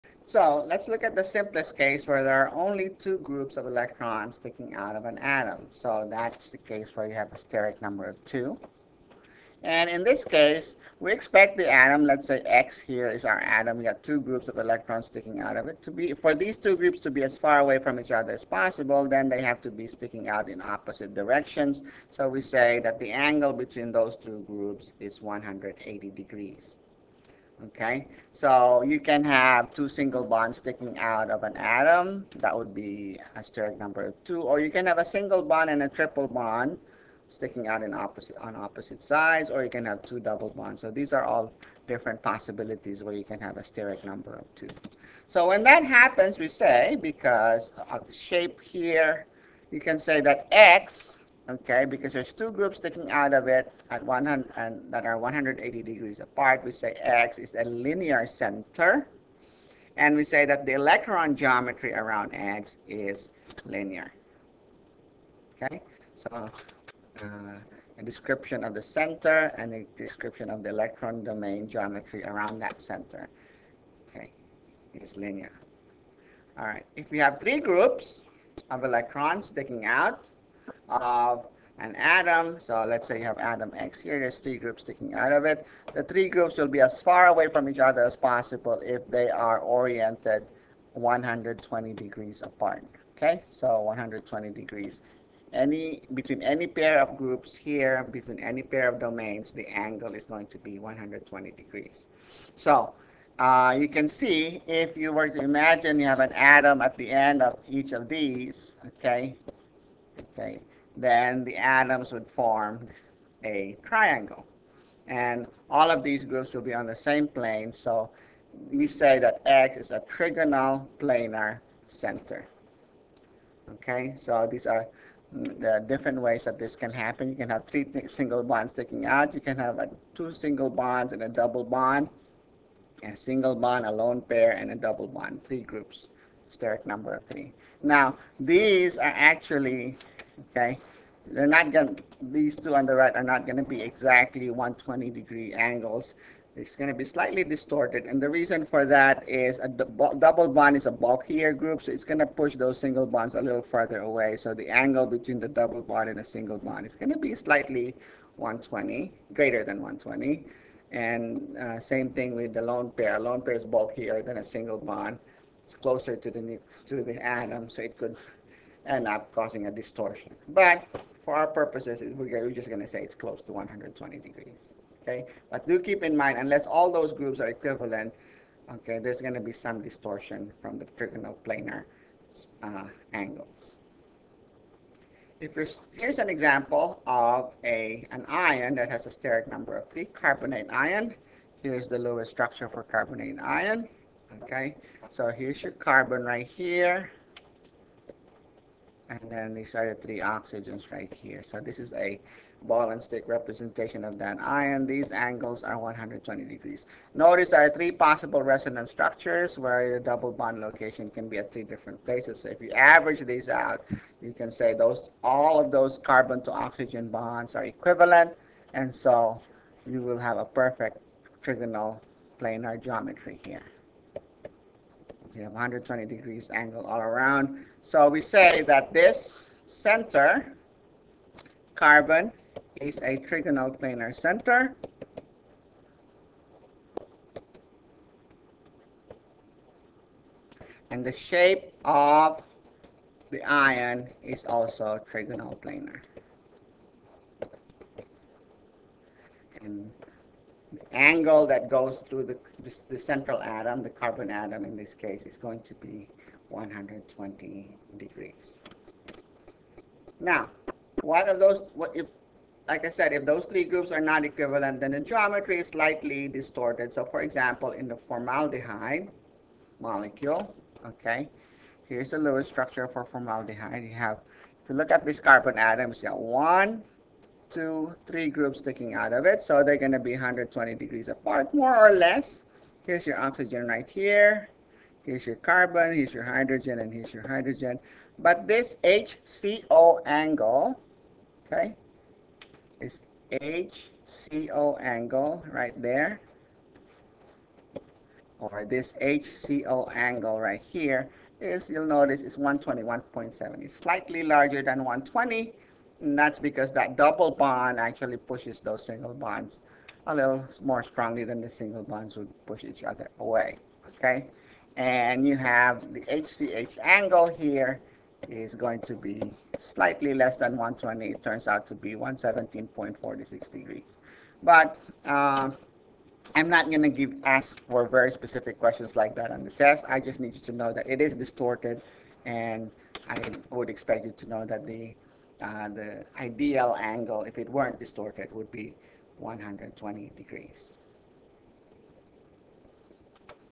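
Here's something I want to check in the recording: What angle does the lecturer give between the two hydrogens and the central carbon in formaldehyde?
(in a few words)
117.46 degrees.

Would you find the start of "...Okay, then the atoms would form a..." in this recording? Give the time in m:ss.
1:50.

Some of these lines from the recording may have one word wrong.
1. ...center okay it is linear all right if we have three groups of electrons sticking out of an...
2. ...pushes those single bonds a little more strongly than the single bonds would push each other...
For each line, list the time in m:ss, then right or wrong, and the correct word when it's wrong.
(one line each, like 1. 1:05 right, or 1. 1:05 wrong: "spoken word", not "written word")
1. 1:12 right
2. 5:08 right.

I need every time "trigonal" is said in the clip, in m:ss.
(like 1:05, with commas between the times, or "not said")
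2:00, 3:00, 3:41, 3:53, 4:05.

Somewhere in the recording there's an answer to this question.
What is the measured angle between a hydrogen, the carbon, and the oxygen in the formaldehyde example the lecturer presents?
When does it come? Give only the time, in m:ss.
5:02.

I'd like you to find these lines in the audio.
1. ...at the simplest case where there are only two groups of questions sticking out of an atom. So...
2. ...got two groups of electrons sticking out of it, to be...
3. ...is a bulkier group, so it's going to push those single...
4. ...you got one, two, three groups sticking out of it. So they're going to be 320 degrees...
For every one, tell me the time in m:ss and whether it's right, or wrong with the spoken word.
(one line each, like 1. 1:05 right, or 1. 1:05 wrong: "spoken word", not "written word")
1. 0:01 wrong: "electrons", not "questions"
2. 0:13 right
3. 2:30 right
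4. 4:35 wrong: "120", not "320".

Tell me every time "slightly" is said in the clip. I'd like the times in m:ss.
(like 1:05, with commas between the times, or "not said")
2:27, 2:37, 4:25, 5:03, 5:19.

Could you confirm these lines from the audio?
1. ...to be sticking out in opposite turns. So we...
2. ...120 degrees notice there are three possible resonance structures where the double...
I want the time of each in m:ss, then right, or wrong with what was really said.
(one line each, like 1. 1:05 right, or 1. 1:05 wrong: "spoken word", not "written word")
1. 0:19 wrong: "directions", not "turns"
2. 3:25 right.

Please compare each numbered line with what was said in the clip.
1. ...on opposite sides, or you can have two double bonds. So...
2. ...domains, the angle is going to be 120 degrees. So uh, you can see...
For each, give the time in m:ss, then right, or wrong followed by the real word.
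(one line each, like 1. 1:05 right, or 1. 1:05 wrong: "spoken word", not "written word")
1. 0:38 right
2. 1:39 right.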